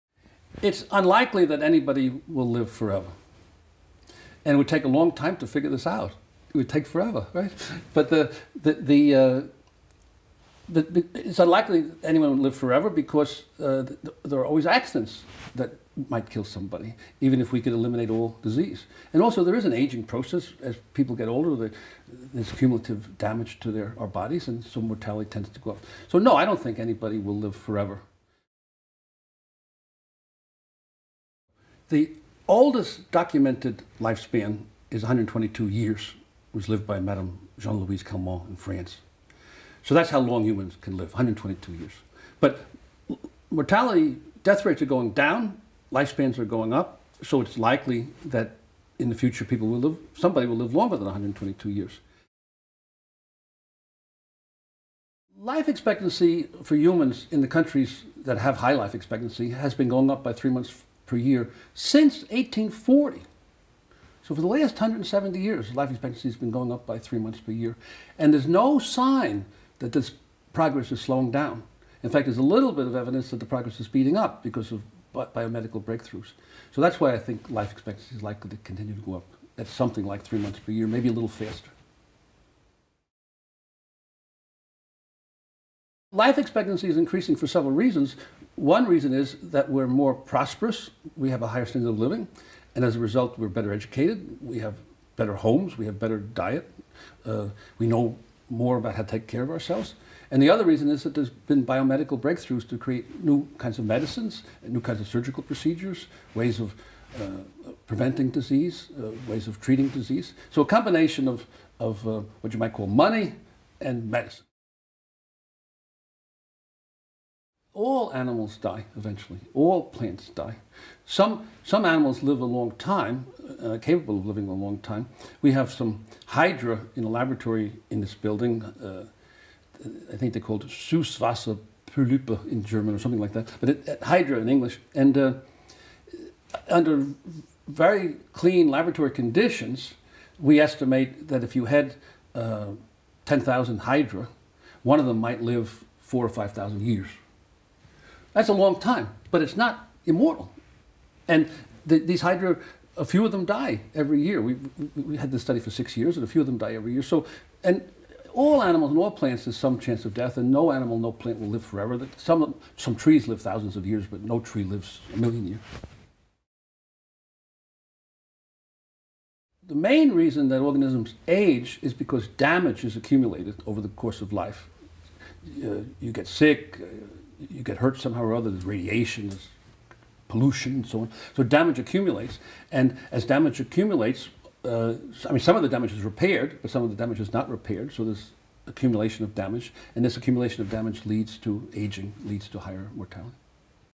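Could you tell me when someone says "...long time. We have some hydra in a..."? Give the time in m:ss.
2:04.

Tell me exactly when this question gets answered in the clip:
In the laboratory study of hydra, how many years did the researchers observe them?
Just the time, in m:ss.
2:35.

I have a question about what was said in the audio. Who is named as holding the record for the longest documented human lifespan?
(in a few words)
Jeanne-Louise Calment.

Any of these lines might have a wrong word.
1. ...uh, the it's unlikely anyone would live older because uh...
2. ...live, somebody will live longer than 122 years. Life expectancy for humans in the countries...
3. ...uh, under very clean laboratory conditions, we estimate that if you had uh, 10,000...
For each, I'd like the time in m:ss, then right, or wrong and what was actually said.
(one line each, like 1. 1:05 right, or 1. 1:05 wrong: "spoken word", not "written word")
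1. 0:09 wrong: "forever", not "older"
2. 0:49 right
3. 2:15 right.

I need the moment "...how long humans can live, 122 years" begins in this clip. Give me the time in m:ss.
0:40.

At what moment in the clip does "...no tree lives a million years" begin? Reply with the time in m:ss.
2:44.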